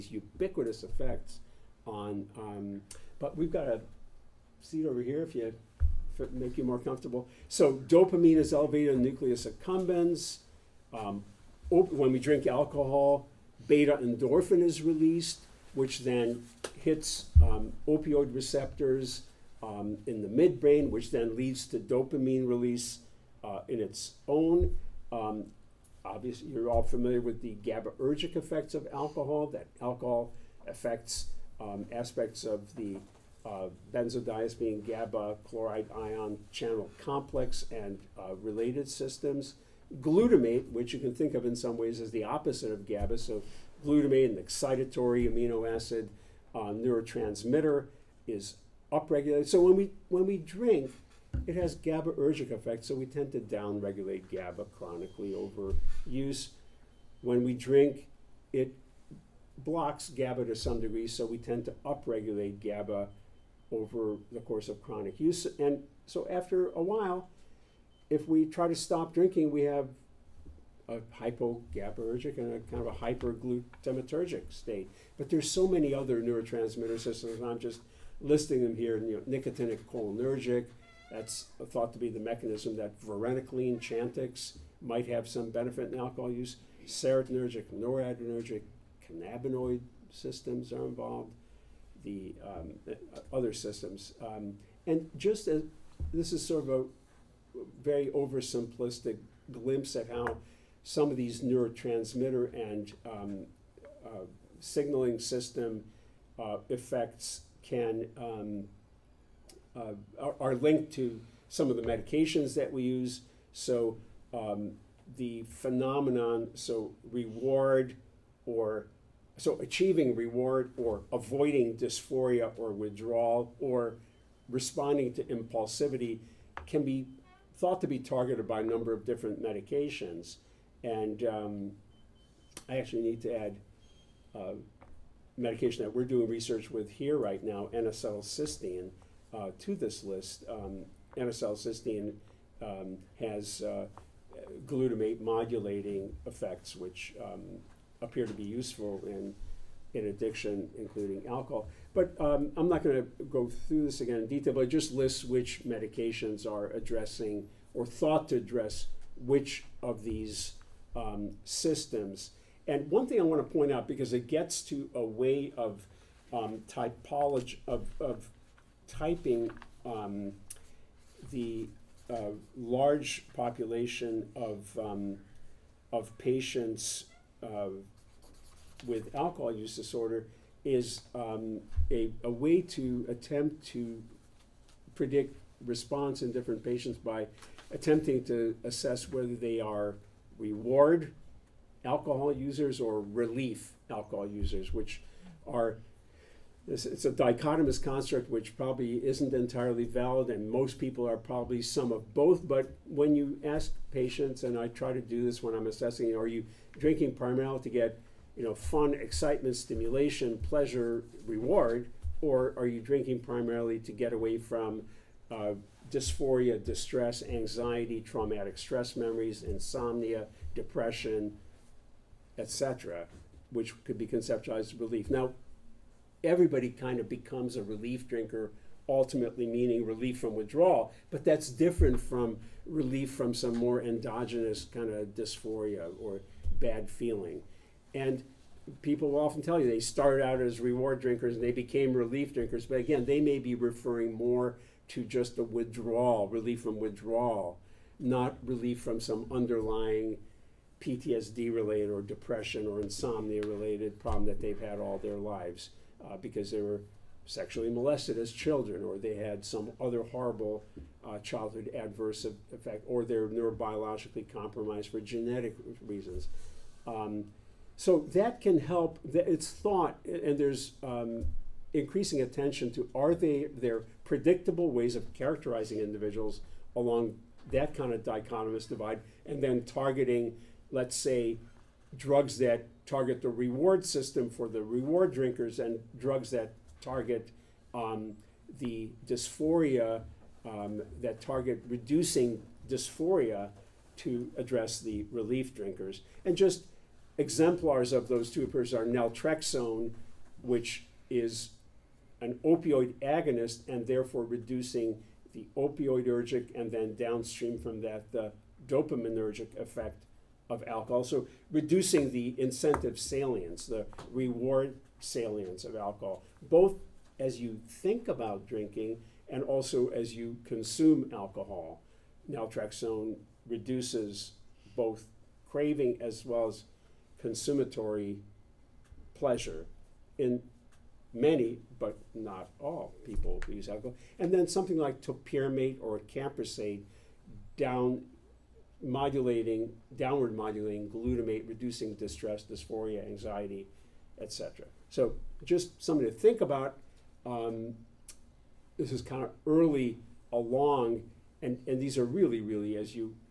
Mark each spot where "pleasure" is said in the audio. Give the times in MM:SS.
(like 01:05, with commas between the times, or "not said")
03:30, 05:29.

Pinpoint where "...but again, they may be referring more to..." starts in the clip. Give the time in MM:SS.
04:02.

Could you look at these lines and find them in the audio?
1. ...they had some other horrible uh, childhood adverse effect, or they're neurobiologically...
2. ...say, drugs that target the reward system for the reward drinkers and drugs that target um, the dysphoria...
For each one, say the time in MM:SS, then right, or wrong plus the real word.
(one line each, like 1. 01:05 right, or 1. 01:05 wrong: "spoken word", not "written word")
1. 04:18 right
2. 04:40 right.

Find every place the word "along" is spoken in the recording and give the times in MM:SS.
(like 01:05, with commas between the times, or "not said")
04:36, 05:50.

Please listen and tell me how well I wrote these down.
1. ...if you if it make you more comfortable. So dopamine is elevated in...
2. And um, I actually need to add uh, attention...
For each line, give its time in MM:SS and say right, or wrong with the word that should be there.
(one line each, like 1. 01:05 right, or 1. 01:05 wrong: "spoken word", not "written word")
1. 00:05 right
2. 02:10 wrong: "medication", not "attention".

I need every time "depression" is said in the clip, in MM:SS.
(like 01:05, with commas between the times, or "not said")
03:40, 04:12.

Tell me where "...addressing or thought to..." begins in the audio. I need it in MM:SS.
02:36.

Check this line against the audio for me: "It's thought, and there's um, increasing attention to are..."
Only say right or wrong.
right.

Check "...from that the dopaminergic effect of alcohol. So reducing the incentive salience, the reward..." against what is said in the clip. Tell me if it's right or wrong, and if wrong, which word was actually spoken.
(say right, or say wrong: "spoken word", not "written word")
right.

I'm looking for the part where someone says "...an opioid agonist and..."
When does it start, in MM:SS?
05:02.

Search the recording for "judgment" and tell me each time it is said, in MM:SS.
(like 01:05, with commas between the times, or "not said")
not said.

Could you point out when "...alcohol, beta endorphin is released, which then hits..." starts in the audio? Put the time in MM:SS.
00:12.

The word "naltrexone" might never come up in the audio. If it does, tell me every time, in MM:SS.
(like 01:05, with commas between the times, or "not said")
04:58, 05:22.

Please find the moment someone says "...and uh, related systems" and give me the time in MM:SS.
00:37.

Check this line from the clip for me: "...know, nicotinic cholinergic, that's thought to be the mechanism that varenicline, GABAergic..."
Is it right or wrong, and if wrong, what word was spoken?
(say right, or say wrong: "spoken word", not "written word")
wrong: "Chantix", not "GABAergic".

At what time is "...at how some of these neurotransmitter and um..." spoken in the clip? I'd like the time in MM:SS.
01:39.